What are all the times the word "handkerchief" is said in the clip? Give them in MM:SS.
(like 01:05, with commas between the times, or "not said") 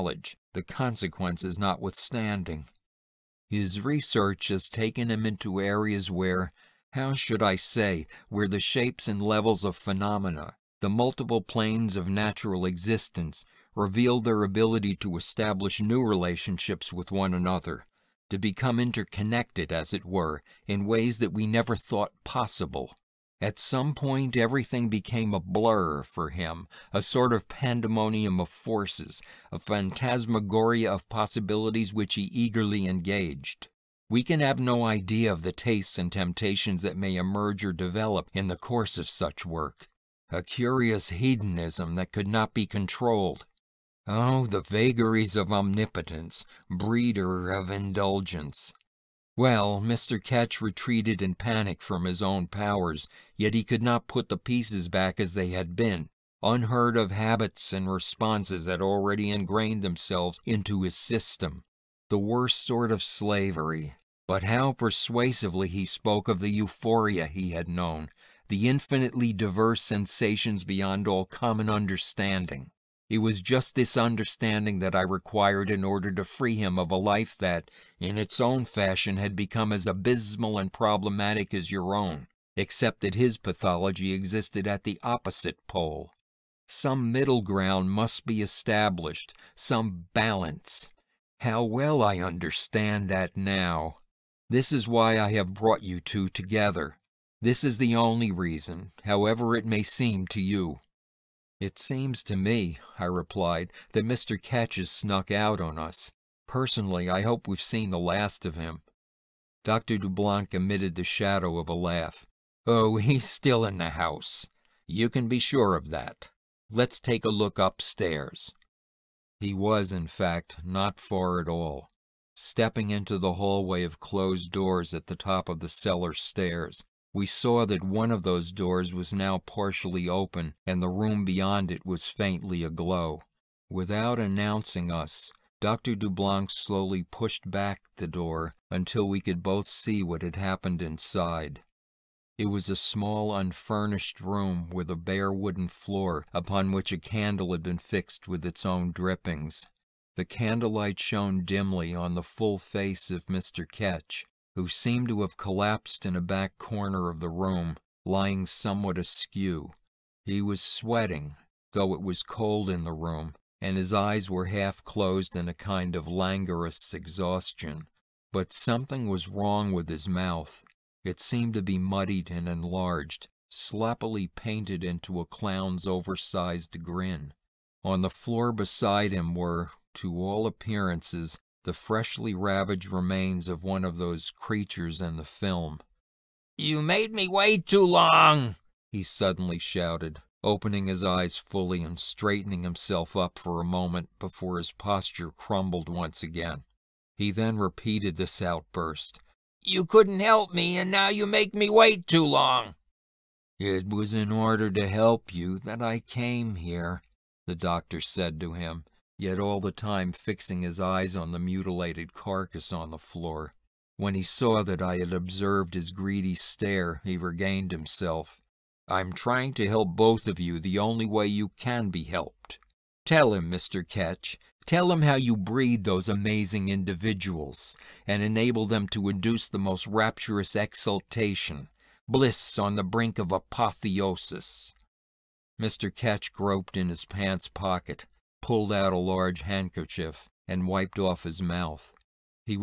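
03:59.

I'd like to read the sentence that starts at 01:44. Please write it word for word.
Ketch has snuck out on us.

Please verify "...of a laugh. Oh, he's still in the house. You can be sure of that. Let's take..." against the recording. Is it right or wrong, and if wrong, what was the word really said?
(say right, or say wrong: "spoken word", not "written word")
right.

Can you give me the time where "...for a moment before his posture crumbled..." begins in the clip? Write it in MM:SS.
03:13.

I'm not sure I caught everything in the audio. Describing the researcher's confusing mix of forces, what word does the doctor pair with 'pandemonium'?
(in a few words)
phantasmagoria.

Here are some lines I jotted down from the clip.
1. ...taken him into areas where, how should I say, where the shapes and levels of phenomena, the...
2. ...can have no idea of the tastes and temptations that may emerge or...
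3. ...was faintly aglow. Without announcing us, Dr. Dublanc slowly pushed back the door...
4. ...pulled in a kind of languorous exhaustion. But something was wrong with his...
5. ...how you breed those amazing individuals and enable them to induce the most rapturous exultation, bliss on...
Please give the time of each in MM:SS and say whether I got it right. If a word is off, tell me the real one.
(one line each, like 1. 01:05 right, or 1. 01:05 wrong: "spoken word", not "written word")
1. 00:04 right
2. 00:34 right
3. 02:11 right
4. 02:44 wrong: "closed", not "pulled"
5. 03:45 right.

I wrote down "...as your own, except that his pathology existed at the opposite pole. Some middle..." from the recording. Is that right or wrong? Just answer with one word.
right.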